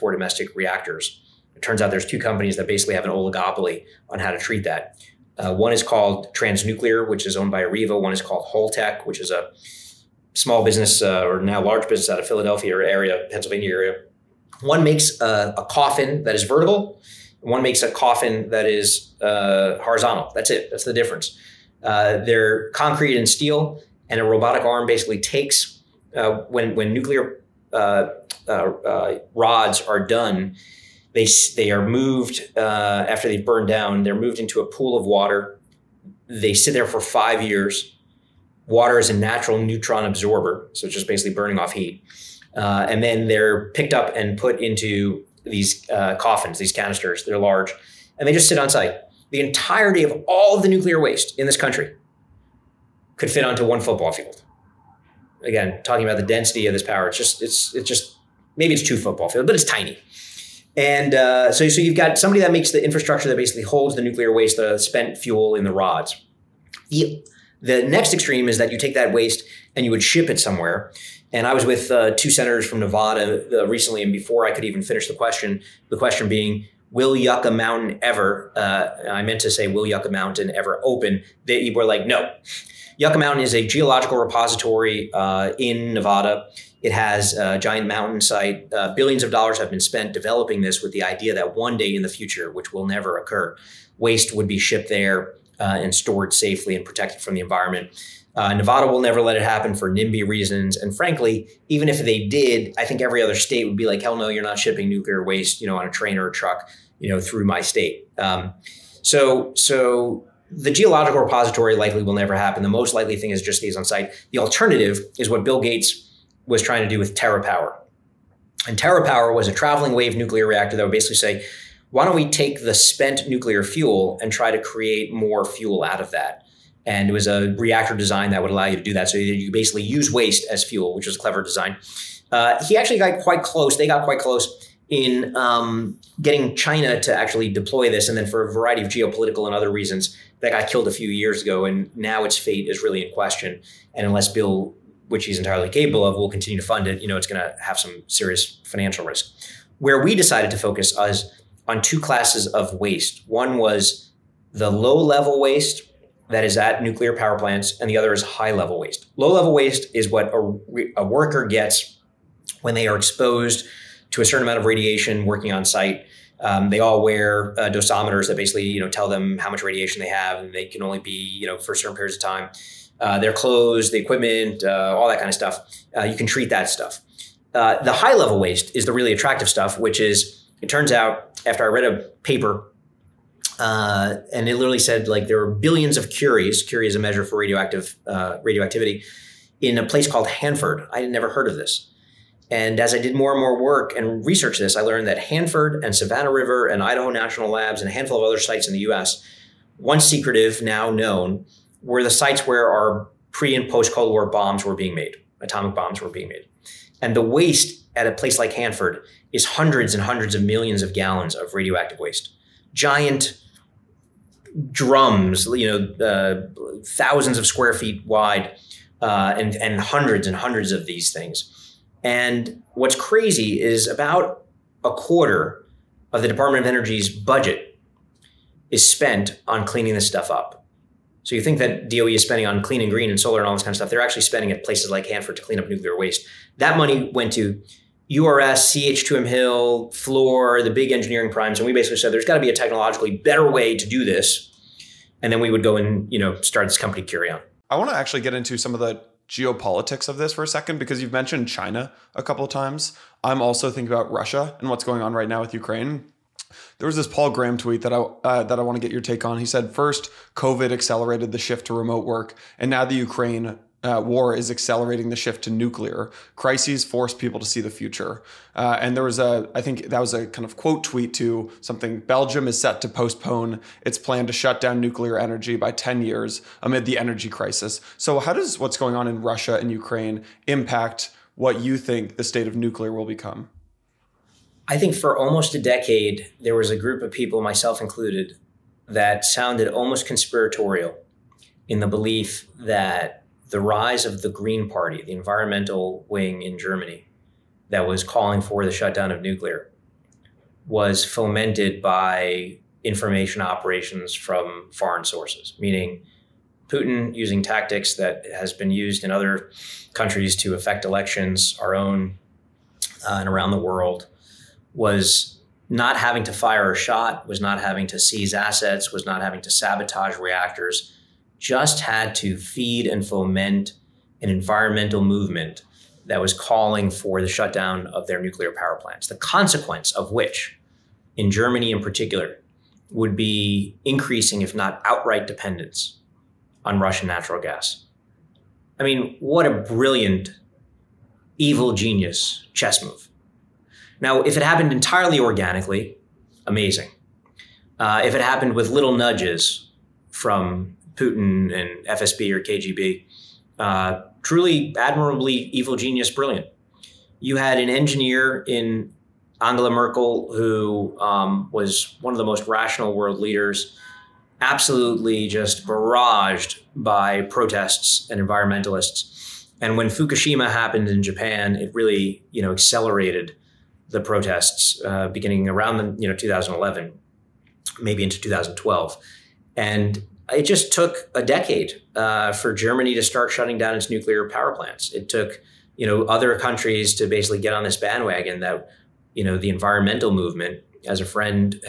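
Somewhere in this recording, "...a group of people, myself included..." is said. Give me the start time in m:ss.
4:46.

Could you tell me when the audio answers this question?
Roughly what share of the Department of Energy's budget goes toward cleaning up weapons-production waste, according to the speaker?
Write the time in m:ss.
3:43.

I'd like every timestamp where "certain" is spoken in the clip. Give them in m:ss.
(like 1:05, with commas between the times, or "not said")
2:44, 2:51.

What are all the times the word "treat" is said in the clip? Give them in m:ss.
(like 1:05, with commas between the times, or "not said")
0:04, 2:56.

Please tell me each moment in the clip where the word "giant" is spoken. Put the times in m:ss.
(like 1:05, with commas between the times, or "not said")
1:27, 3:32.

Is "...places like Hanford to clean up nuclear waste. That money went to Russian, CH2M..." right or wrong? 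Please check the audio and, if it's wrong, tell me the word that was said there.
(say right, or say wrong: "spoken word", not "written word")
wrong: "URS", not "Russian".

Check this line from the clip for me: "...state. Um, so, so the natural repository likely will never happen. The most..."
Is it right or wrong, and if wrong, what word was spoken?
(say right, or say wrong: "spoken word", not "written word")
wrong: "geological", not "natural".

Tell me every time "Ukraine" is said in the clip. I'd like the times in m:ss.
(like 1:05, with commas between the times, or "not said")
4:15, 4:22, 4:39.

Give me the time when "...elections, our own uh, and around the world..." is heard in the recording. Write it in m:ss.
5:10.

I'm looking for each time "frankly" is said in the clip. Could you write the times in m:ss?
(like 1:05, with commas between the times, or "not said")
1:40.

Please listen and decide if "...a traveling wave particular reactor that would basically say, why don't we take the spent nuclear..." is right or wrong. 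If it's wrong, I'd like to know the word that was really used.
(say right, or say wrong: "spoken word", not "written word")
wrong: "nuclear", not "particular".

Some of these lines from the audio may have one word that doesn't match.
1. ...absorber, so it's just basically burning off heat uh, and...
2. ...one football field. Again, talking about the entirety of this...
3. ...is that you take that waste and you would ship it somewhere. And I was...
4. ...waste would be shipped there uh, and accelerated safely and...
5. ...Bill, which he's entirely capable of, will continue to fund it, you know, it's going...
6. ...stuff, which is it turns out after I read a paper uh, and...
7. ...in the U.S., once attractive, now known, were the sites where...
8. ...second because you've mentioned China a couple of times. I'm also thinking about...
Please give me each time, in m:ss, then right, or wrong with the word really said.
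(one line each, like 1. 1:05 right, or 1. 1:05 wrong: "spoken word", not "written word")
1. 0:40 right
2. 0:53 wrong: "density", not "entirety"
3. 1:08 right
4. 1:33 wrong: "stored", not "accelerated"
5. 2:24 right
6. 2:59 right
7. 3:18 wrong: "secretive", not "attractive"
8. 4:10 right.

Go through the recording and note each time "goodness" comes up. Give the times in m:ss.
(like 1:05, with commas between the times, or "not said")
not said.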